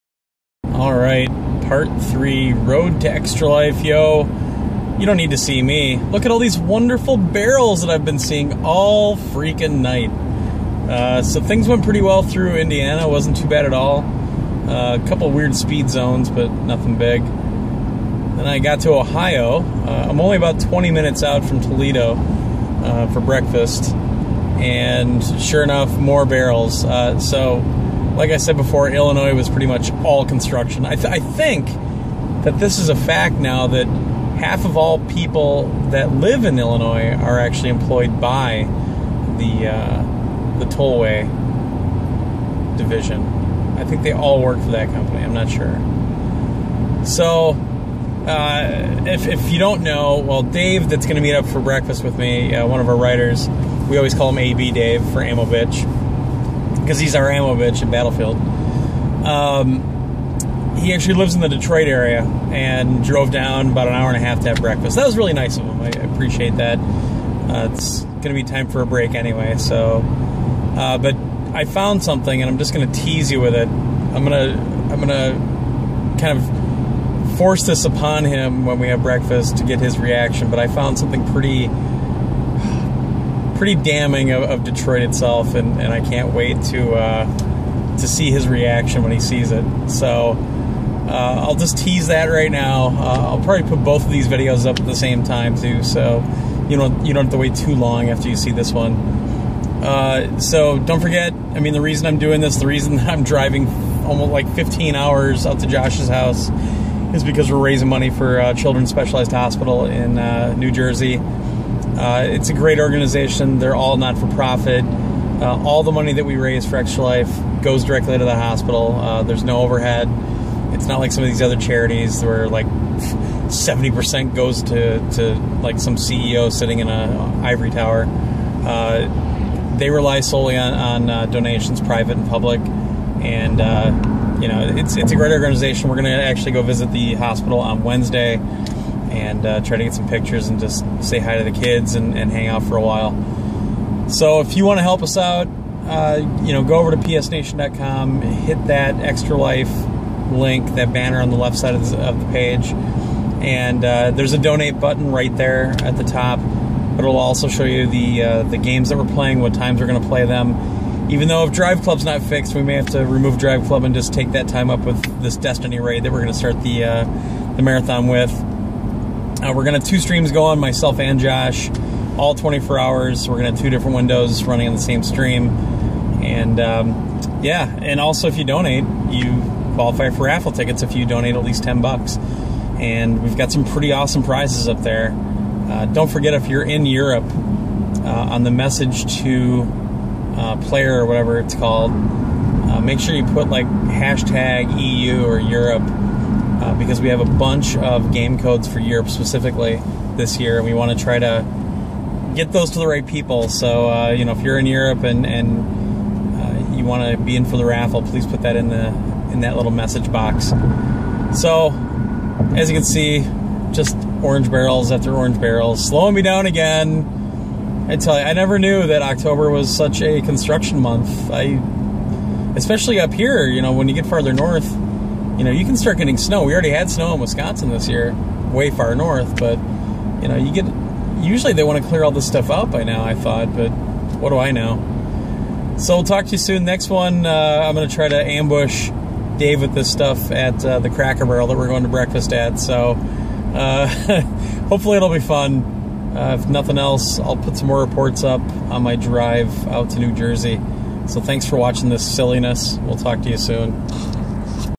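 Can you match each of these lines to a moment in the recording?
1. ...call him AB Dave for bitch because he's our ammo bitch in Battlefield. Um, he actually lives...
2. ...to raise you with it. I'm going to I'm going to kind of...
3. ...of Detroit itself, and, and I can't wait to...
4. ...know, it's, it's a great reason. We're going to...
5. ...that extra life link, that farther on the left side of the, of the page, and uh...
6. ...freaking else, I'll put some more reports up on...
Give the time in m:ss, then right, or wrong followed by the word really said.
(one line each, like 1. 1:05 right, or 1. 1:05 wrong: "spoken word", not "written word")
1. 0:54 right
2. 1:12 wrong: "tease", not "raise"
3. 1:24 right
4. 2:14 wrong: "organization", not "reason"
5. 2:28 wrong: "banner", not "farther"
6. 4:06 wrong: "nothing", not "freaking".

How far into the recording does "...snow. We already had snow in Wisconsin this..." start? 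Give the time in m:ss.
3:46.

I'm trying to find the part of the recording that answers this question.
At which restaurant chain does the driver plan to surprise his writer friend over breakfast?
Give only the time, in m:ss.
4:00.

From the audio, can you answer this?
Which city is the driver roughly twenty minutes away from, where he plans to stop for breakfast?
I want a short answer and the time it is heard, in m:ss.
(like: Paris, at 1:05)
Toledo, at 0:21.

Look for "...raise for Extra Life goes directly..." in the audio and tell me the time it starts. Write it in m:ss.
1:56.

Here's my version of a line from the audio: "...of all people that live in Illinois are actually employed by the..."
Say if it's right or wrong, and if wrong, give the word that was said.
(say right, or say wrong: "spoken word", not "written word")
right.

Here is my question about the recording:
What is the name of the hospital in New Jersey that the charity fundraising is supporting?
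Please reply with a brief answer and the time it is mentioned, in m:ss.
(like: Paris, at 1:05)
Children's Specialized Hospital, at 1:48.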